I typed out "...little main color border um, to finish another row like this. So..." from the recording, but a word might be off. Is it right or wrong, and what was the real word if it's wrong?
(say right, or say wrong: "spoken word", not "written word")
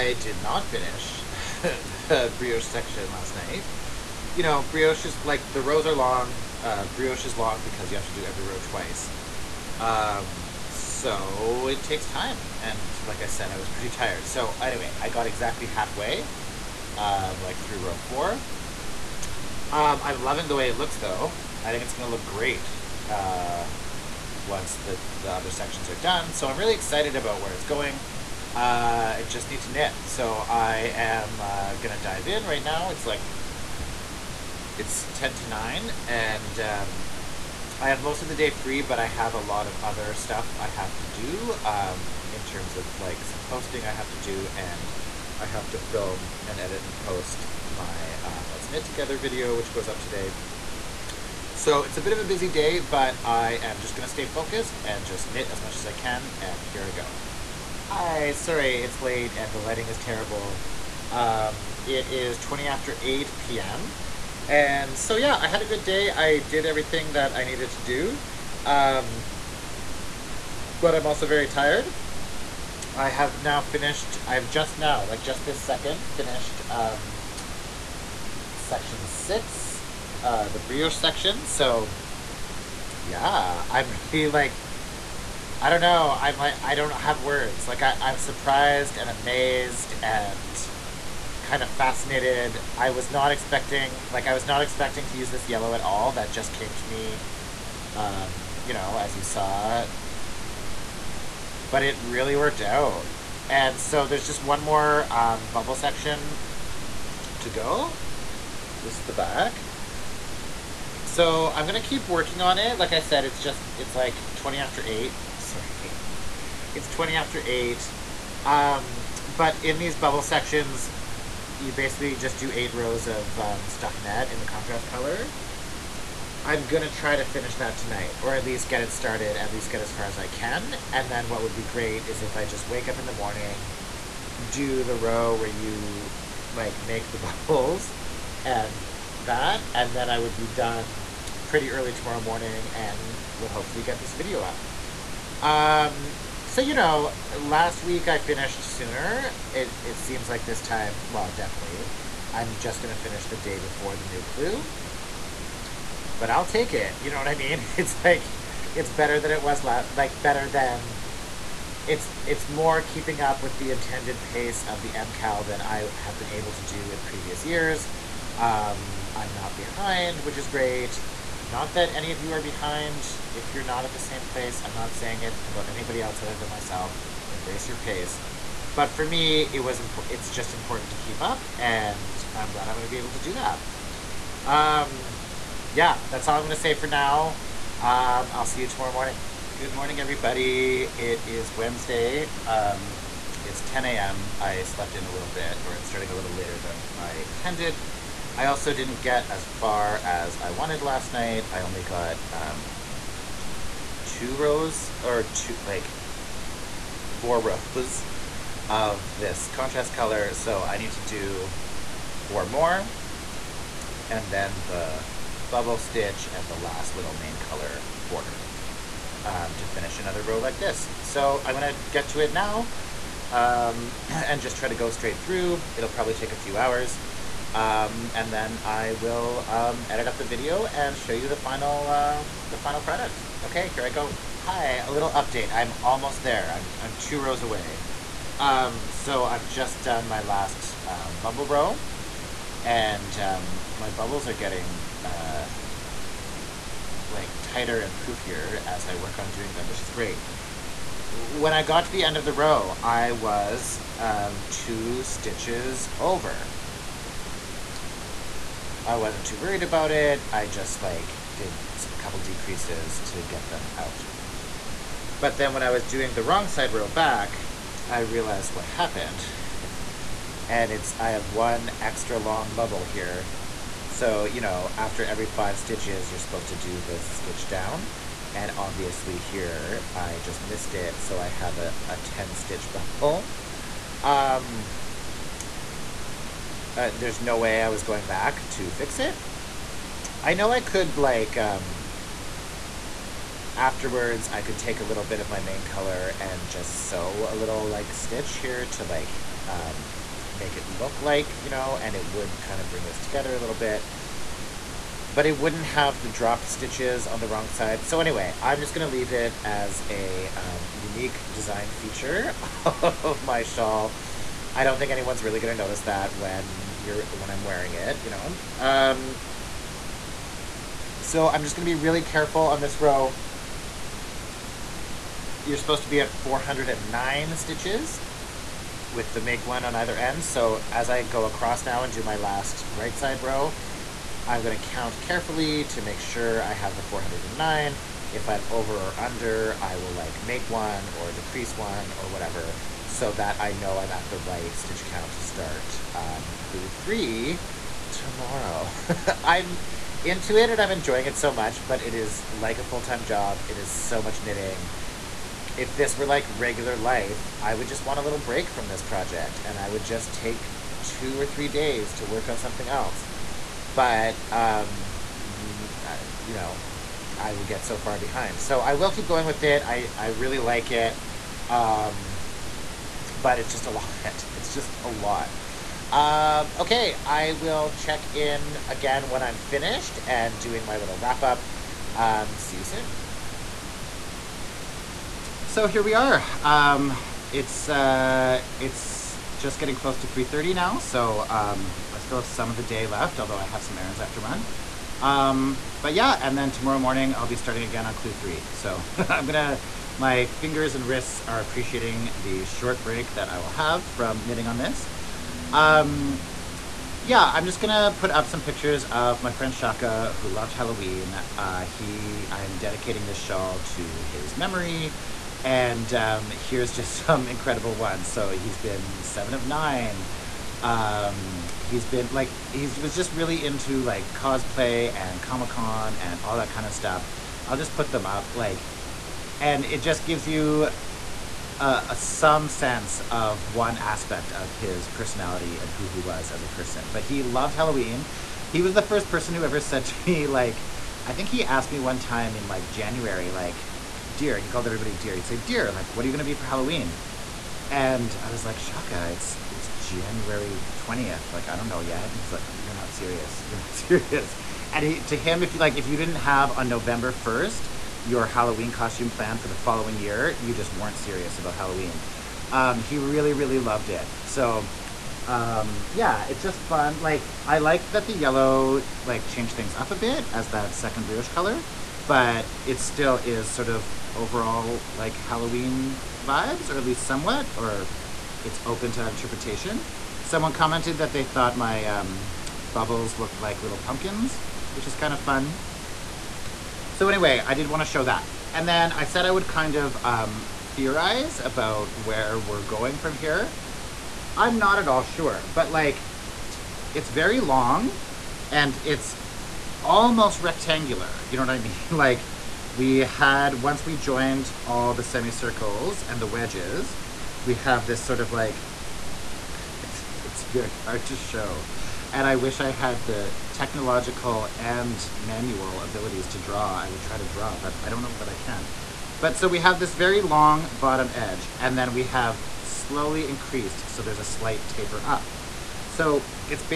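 right.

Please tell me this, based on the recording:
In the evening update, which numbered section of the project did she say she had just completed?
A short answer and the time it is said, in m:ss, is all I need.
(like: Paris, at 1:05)
section 6, at 1:18.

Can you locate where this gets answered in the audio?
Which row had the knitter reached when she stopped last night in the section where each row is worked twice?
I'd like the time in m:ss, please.
0:17.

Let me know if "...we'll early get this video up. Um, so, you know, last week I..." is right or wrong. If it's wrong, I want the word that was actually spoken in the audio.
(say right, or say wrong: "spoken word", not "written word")
wrong: "hopefully", not "early".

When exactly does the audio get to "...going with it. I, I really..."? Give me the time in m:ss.
6:09.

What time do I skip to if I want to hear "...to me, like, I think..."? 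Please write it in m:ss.
7:19.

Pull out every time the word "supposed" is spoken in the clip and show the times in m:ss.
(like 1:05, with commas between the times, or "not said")
4:36, 5:25.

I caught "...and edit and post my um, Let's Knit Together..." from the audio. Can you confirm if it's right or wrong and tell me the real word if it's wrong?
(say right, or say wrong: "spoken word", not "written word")
right.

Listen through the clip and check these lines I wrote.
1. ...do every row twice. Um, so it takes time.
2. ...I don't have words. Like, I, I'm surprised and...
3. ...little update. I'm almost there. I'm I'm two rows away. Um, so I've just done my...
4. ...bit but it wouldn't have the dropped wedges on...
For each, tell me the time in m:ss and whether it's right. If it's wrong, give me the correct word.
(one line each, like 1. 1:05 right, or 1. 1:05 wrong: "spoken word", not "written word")
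1. 0:08 right
2. 1:26 right
3. 3:54 right
4. 5:03 wrong: "stitches", not "wedges".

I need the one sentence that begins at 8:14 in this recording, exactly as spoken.
I'm not at all sure, but like it's very long and it's almost rectangular.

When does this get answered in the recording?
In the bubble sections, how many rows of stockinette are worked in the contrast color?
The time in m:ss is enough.
2:02.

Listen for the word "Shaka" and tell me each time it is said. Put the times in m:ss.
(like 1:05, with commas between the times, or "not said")
6:49, 7:28.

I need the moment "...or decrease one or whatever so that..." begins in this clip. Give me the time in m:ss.
5:40.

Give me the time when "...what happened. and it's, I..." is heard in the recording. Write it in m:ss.
4:28.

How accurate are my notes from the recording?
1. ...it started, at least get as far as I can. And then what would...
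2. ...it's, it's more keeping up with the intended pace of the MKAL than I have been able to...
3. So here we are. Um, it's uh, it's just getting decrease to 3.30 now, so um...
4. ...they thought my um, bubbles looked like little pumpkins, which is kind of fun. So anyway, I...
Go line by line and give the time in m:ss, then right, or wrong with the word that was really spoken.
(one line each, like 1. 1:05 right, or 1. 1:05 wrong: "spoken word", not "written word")
1. 2:08 right
2. 2:41 right
3. 6:25 wrong: "close", not "decrease"
4. 8:01 right.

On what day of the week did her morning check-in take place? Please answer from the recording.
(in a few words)
Wednesday.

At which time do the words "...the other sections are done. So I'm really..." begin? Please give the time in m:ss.
0:25.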